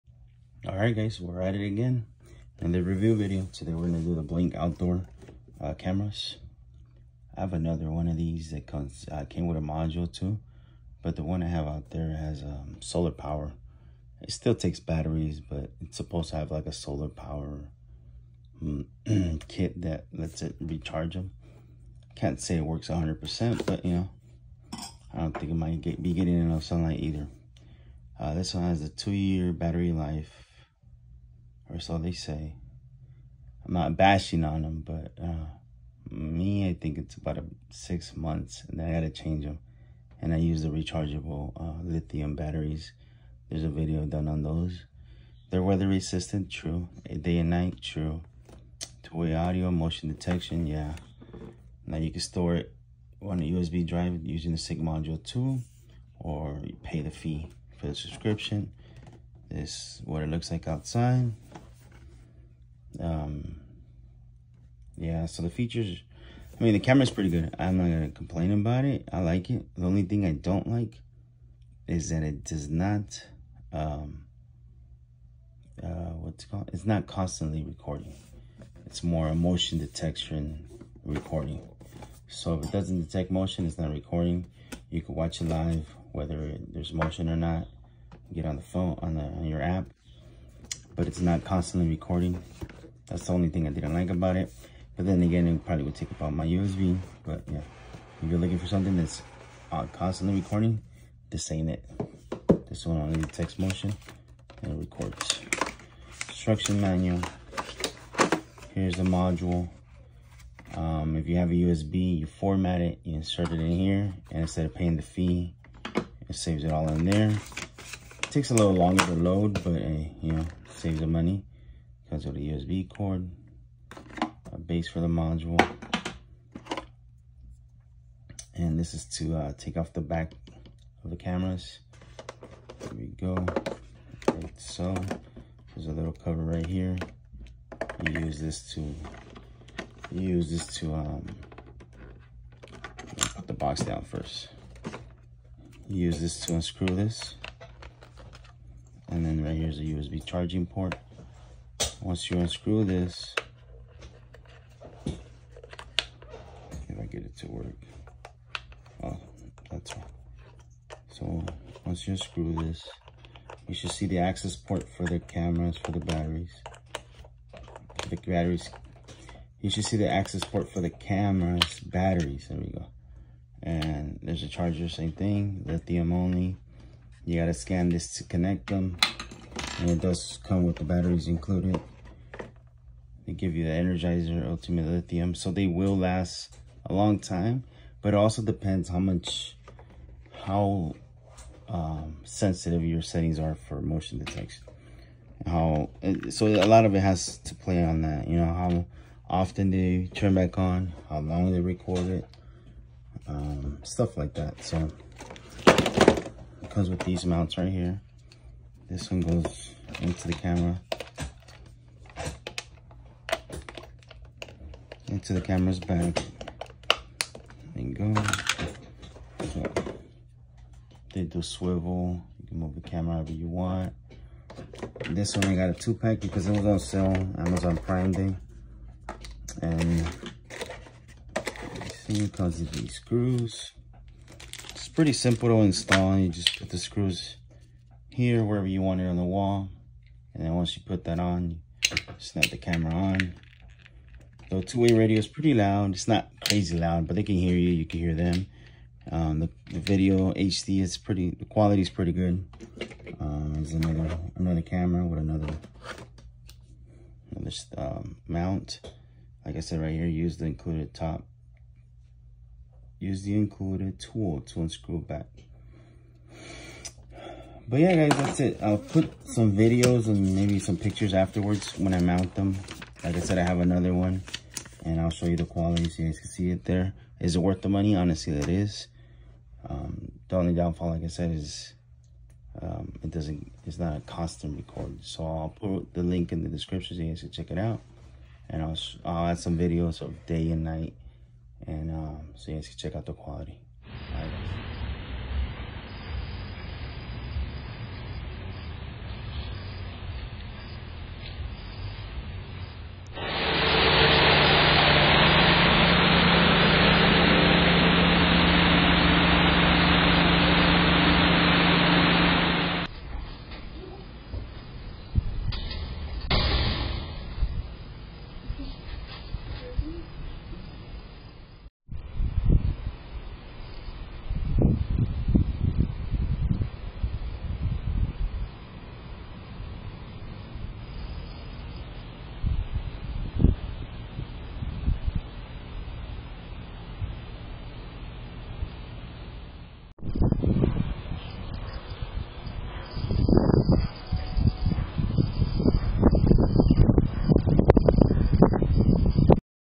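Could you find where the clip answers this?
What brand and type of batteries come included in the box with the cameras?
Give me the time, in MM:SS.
03:03.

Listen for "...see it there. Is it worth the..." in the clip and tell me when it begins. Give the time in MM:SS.
04:36.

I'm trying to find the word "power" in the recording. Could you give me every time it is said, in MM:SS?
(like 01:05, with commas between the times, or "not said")
00:13, 00:17.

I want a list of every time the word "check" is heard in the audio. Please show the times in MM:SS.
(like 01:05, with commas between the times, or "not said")
04:47, 04:52.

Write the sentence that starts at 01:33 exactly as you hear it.
That's the only thing I didn't like about it.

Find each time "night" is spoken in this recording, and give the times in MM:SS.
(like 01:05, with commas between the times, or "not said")
00:47, 04:50.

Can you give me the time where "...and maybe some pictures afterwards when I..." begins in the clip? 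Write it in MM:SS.
04:30.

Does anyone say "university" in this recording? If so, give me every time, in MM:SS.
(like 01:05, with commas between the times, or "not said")
not said.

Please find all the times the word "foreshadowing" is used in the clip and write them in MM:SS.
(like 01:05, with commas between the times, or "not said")
not said.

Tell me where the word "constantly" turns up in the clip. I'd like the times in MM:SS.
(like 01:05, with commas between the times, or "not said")
01:17, 01:31, 01:39.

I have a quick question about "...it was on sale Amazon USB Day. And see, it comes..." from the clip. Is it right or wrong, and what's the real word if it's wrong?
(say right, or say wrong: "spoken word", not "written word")
wrong: "Prime", not "USB".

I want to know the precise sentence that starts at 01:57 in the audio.
It takes a little longer to load, but uh, you know, saves the money.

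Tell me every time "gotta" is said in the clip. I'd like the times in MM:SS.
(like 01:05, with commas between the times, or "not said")
00:38, 02:57.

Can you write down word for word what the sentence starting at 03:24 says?
So it comes with these mounts right here.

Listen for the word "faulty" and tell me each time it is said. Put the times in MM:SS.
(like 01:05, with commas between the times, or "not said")
not said.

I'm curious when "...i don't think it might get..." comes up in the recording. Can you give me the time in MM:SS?
00:25.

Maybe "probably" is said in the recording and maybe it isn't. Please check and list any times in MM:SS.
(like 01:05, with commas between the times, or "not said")
01:35.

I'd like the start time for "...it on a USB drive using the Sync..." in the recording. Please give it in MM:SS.
00:52.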